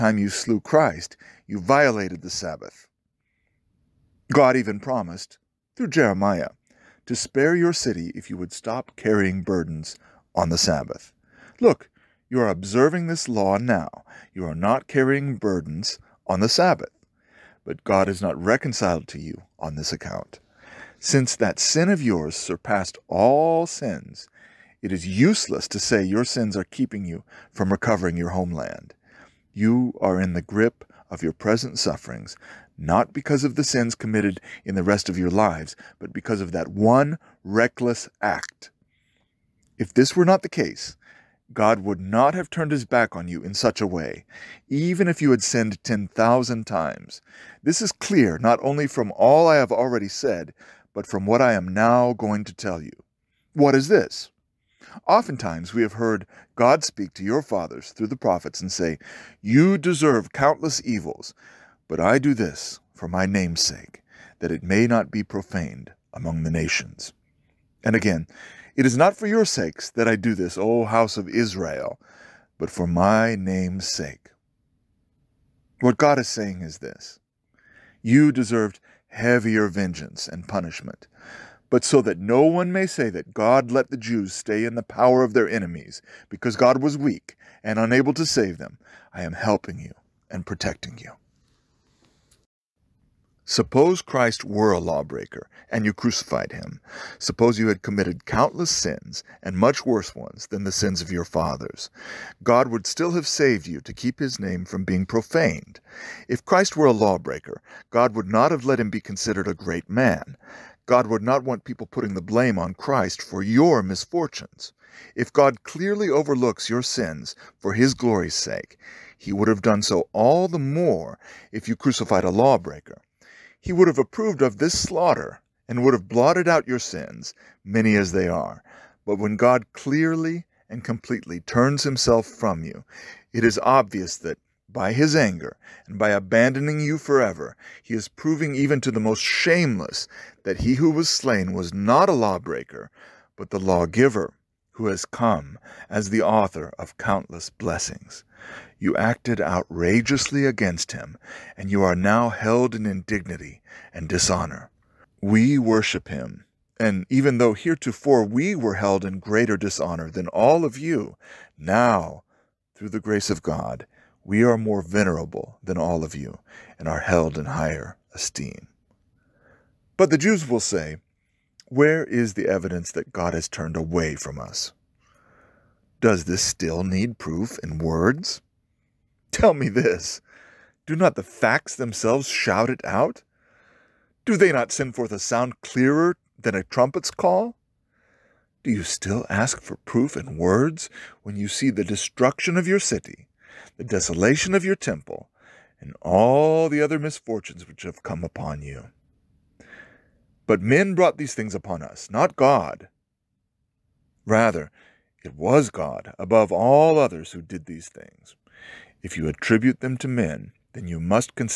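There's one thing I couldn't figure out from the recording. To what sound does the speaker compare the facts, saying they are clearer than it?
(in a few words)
a trumpet's call.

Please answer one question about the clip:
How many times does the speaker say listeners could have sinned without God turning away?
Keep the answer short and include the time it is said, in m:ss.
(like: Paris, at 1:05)
10,000, at 0:45.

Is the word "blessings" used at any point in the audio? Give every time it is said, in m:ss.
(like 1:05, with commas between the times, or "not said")
2:27.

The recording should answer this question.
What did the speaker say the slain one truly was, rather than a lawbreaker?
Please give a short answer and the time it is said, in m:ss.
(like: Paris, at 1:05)
the lawgiver, at 2:23.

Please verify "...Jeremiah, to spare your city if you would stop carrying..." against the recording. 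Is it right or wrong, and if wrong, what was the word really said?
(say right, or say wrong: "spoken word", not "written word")
right.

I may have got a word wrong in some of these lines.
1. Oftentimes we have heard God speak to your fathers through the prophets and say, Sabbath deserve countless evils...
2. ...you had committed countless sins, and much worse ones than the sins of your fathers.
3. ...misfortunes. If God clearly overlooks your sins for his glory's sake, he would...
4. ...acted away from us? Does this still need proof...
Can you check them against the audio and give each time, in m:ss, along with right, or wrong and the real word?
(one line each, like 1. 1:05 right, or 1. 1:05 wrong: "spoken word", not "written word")
1. 0:55 wrong: "You", not "Sabbath"
2. 1:37 right
3. 1:53 right
4. 2:53 wrong: "turned", not "acted".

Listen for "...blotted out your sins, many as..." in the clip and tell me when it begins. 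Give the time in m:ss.
2:06.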